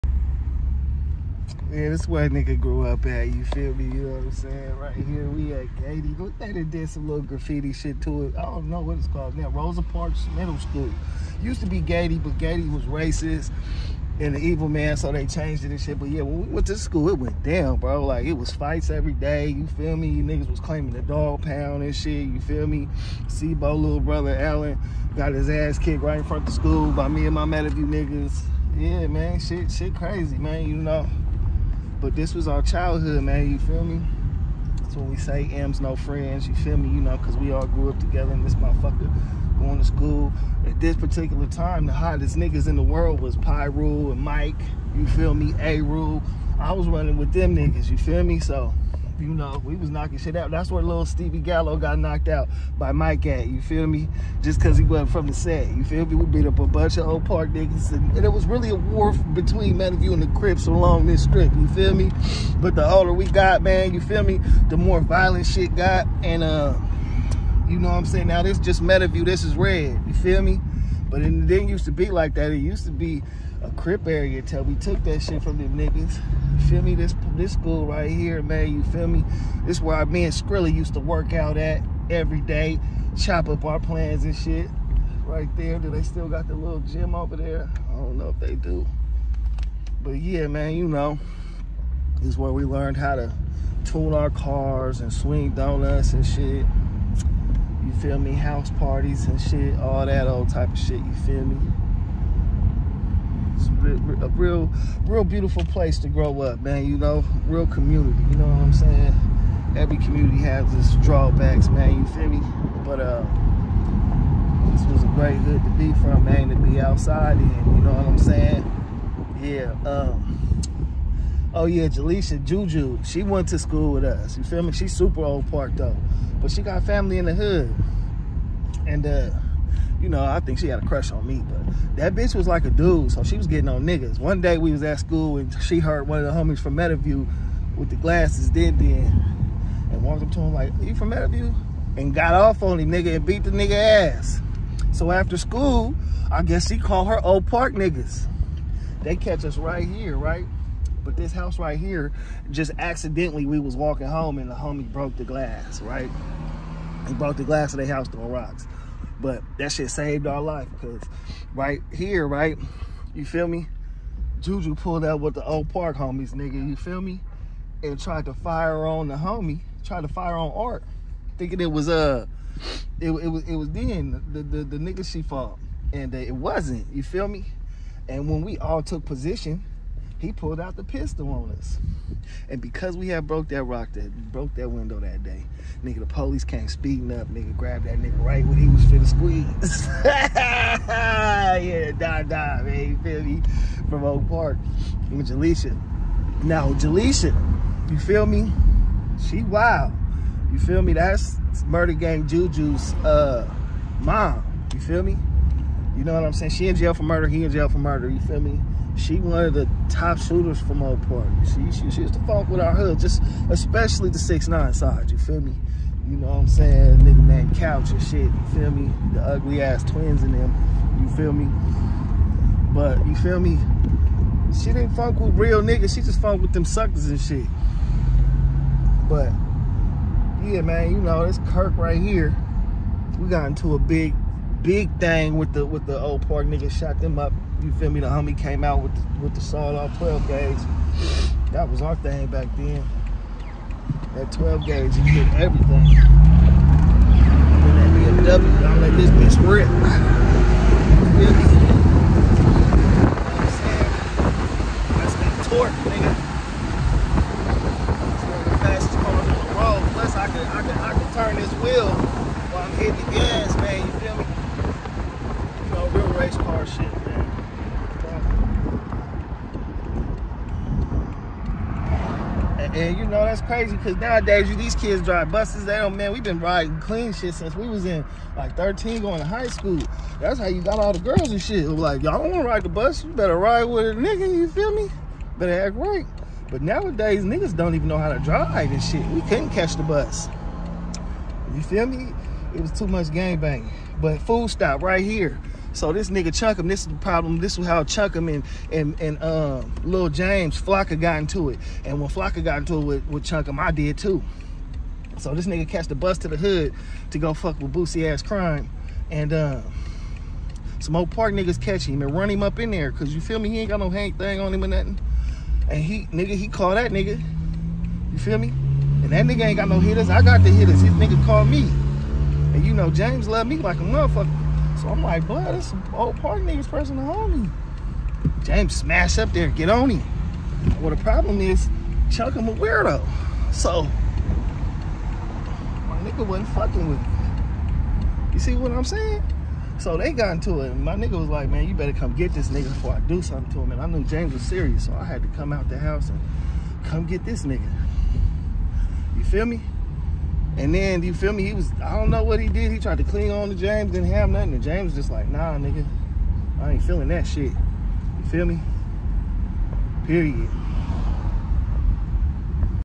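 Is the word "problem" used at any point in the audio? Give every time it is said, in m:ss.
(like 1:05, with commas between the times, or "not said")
4:56, 5:31.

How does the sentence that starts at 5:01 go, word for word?
And when Flocka got into it with, with him, I did too.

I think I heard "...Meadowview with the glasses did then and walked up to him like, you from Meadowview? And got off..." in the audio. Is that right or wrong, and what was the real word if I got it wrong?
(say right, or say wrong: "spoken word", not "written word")
right.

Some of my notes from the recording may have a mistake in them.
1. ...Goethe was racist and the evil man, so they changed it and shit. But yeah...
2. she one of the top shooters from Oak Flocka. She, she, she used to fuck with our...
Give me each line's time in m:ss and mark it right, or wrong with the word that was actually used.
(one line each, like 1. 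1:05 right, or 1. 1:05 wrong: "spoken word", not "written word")
1. 0:12 right
2. 3:28 wrong: "Park", not "Flocka".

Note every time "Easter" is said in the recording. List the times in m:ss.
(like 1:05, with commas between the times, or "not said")
not said.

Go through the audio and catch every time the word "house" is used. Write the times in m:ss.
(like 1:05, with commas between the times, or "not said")
1:38, 2:31, 2:37, 5:45.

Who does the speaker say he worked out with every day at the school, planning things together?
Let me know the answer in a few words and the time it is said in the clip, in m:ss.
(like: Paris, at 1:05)
Skrilly, at 1:20.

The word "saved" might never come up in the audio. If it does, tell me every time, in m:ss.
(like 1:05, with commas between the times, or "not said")
2:39.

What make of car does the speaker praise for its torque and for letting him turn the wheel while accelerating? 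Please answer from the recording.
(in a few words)
BMW.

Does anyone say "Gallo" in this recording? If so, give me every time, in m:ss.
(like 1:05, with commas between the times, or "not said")
0:51.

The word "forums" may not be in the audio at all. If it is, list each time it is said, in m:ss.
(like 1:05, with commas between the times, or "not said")
not said.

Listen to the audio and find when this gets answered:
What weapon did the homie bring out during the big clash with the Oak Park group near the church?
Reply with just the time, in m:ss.
3:59.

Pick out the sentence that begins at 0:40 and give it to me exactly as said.
At this particular time, the hottest niggas in the world was Pyro and Mike.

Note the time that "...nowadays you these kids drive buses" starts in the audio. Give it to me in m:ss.
4:33.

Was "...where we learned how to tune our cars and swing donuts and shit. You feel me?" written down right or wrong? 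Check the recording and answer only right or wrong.
right.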